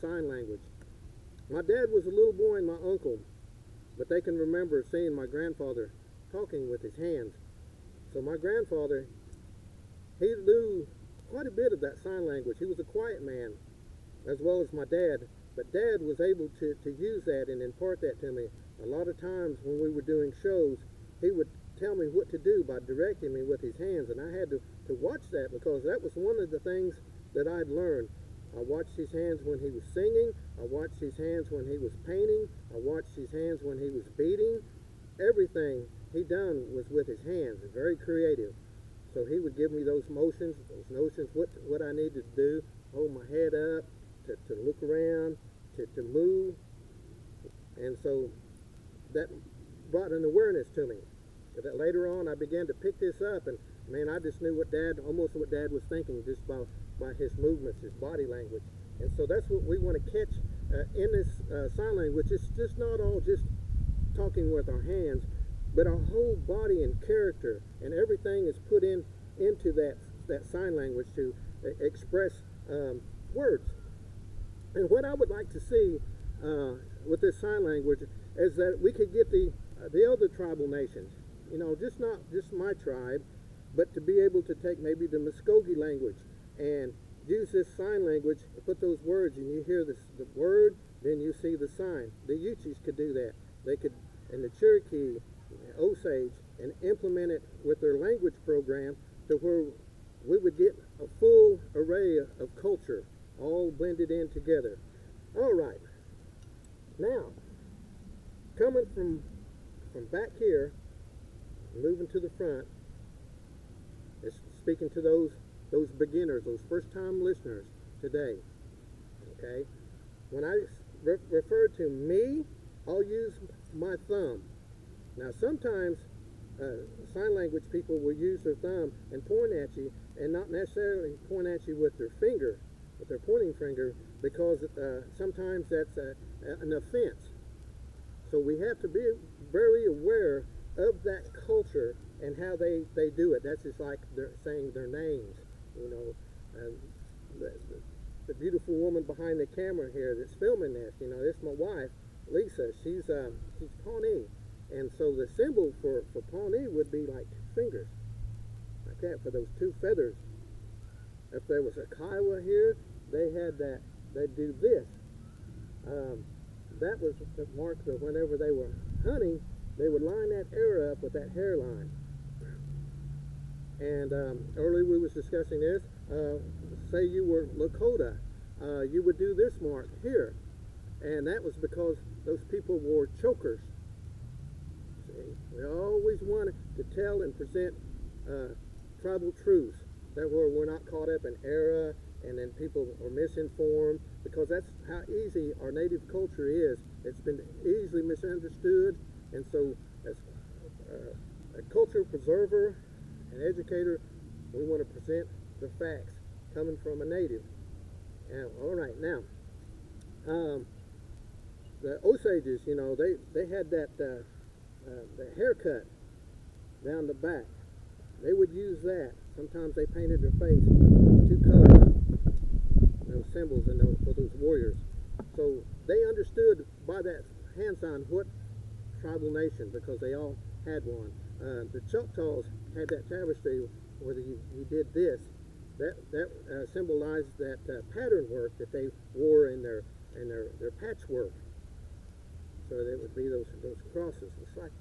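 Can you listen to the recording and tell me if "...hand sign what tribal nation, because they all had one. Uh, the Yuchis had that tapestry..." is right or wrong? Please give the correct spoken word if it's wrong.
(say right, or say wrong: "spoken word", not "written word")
wrong: "Choctaws", not "Yuchis".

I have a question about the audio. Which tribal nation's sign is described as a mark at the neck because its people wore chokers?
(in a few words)
Lakota.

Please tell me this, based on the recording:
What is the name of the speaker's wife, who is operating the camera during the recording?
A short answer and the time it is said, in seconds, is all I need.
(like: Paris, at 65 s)
Lisa, at 152 s.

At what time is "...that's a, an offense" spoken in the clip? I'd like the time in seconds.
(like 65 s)
135 s.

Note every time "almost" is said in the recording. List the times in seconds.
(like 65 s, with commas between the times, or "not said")
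55 s.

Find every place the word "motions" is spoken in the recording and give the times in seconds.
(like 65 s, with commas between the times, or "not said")
40 s.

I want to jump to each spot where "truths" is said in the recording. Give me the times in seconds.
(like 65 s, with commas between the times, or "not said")
189 s.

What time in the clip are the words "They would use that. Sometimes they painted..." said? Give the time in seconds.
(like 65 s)
218 s.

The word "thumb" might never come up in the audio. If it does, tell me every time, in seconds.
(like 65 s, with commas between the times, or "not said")
124 s, 128 s.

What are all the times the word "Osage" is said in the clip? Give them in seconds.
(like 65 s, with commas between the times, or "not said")
95 s, 212 s.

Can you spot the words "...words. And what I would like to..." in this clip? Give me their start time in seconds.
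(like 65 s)
73 s.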